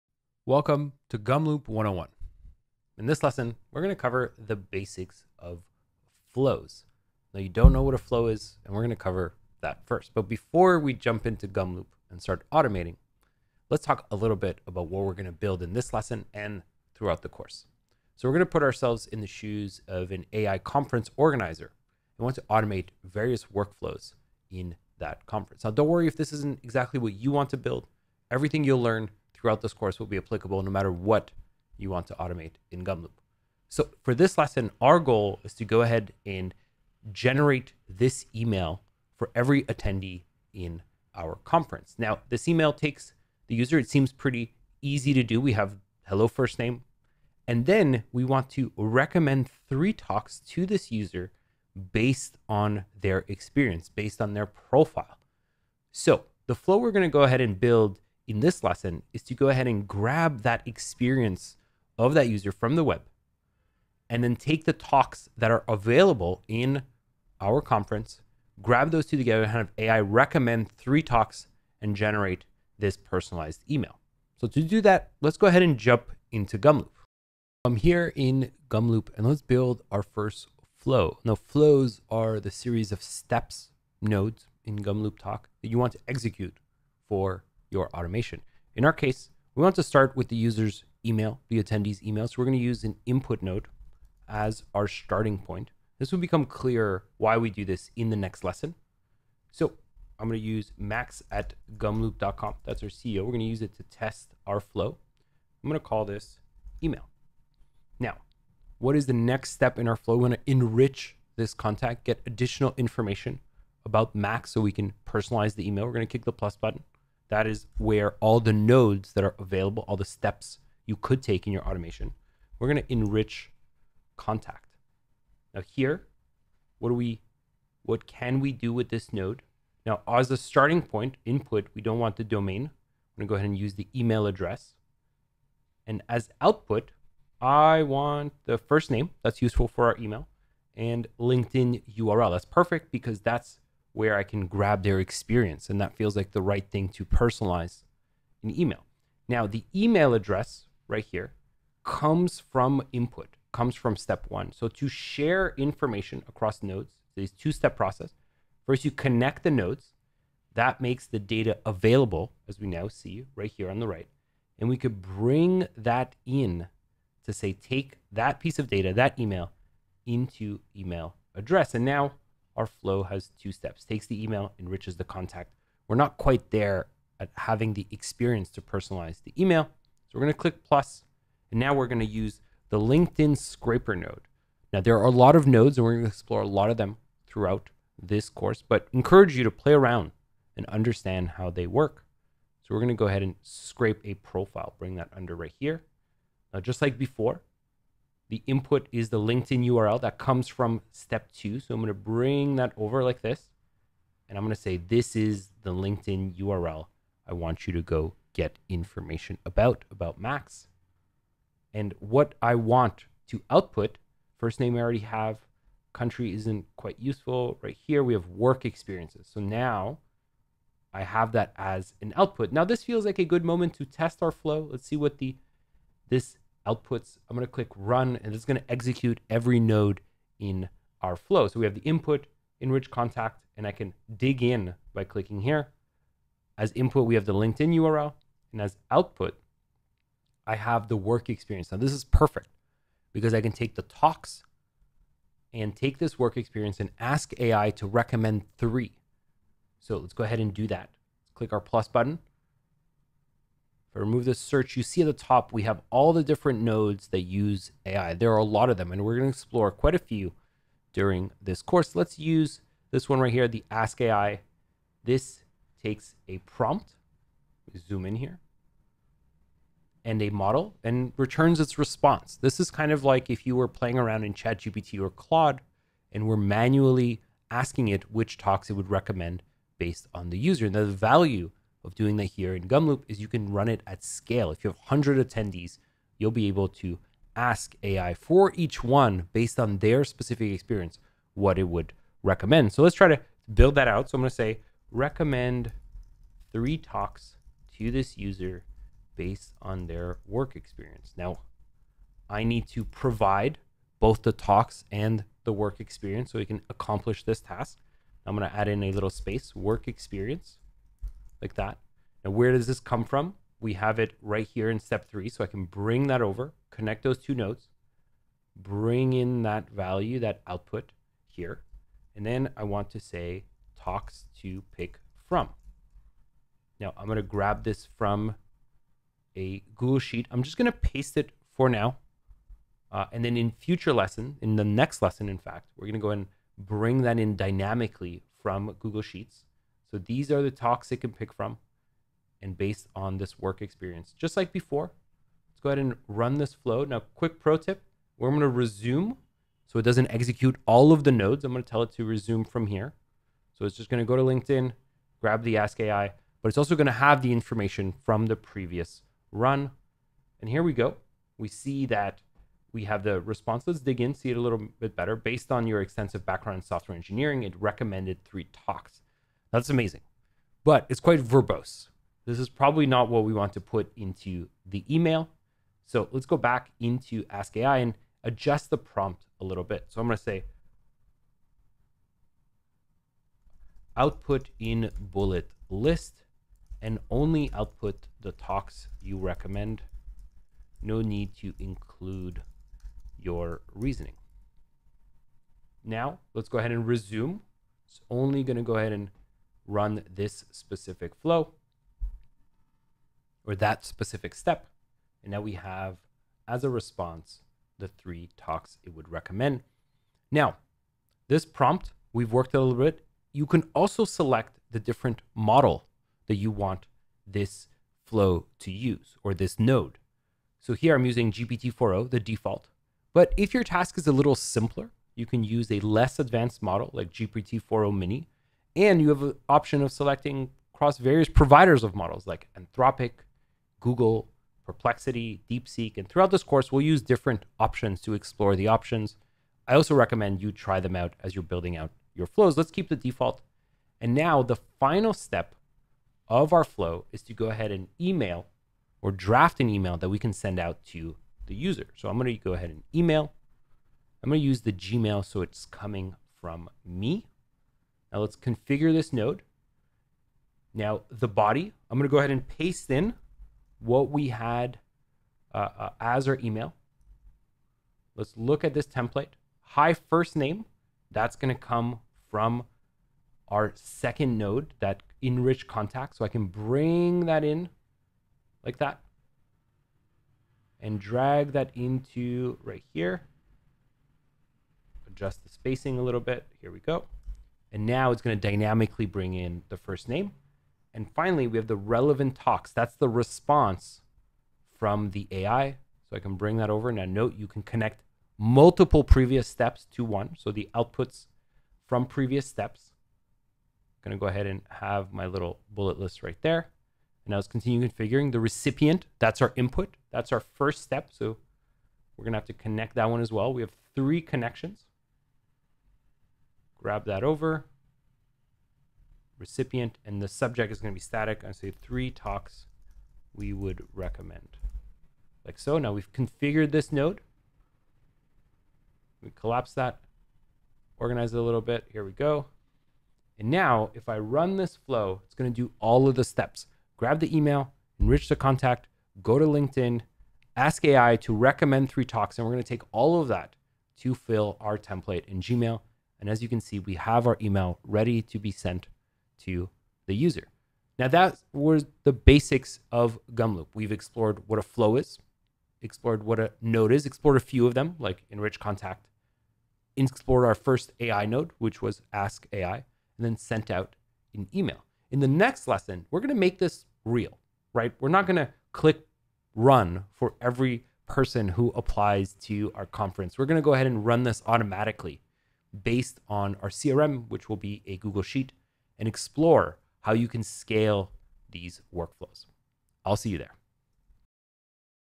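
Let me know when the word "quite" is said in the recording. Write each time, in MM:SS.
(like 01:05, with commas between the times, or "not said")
02:56, 03:36, 04:19, 06:10.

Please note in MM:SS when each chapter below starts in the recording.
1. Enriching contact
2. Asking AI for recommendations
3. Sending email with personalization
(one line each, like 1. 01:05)
1. 01:23
2. 04:04
3. 07:21.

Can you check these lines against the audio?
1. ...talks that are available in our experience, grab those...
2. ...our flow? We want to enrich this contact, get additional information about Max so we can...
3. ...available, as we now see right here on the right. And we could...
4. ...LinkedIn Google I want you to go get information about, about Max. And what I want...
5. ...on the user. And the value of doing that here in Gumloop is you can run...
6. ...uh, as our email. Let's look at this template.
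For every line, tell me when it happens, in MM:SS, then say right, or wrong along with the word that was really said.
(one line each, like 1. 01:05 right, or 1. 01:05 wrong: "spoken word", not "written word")
1. 01:04 wrong: "conference", not "experience"
2. 01:49 right
3. 02:41 right
4. 03:25 wrong: "URL", not "Google"
5. 04:40 right
6. 07:45 right.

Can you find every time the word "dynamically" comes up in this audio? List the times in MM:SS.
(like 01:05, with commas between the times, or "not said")
05:37, 08:08.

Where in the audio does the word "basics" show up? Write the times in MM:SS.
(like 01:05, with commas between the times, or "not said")
00:04, 09:12.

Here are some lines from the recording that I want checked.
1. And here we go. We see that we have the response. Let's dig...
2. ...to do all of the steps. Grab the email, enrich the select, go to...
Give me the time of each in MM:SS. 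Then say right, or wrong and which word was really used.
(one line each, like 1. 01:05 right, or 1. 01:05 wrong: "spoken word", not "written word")
1. 06:00 right
2. 08:55 wrong: "contact", not "select".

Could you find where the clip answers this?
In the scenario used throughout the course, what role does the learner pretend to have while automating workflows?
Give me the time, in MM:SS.
00:20.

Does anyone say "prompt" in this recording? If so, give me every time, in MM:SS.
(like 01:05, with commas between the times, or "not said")
04:26, 06:18, 06:51.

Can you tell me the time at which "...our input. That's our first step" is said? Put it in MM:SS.
08:29.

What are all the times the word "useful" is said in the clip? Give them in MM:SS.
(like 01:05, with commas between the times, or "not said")
02:19, 03:37.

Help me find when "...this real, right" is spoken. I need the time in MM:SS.
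09:26.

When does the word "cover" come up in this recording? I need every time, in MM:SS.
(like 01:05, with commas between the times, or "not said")
00:03, 00:08.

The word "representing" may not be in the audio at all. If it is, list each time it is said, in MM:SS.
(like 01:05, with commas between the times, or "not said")
not said.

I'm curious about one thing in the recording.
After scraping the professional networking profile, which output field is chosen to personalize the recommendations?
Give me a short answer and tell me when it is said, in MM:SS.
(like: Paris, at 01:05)
Work experiences, at 03:38.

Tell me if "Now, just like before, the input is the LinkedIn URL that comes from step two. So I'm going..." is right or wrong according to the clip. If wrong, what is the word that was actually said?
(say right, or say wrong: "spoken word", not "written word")
right.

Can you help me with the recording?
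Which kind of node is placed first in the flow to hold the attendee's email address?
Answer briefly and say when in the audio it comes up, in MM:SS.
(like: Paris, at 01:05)
Input node, at 01:33.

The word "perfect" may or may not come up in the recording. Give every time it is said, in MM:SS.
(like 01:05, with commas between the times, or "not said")
02:22, 04:02.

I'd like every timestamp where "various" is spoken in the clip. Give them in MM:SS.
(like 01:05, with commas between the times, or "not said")
00:23, 07:10.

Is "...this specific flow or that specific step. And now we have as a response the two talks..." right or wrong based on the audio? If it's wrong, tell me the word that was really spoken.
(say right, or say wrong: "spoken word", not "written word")
wrong: "three", not "two".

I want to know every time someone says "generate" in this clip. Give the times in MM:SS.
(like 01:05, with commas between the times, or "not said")
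00:37, 01:11.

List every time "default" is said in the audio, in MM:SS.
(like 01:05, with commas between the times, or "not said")
07:02, 07:22.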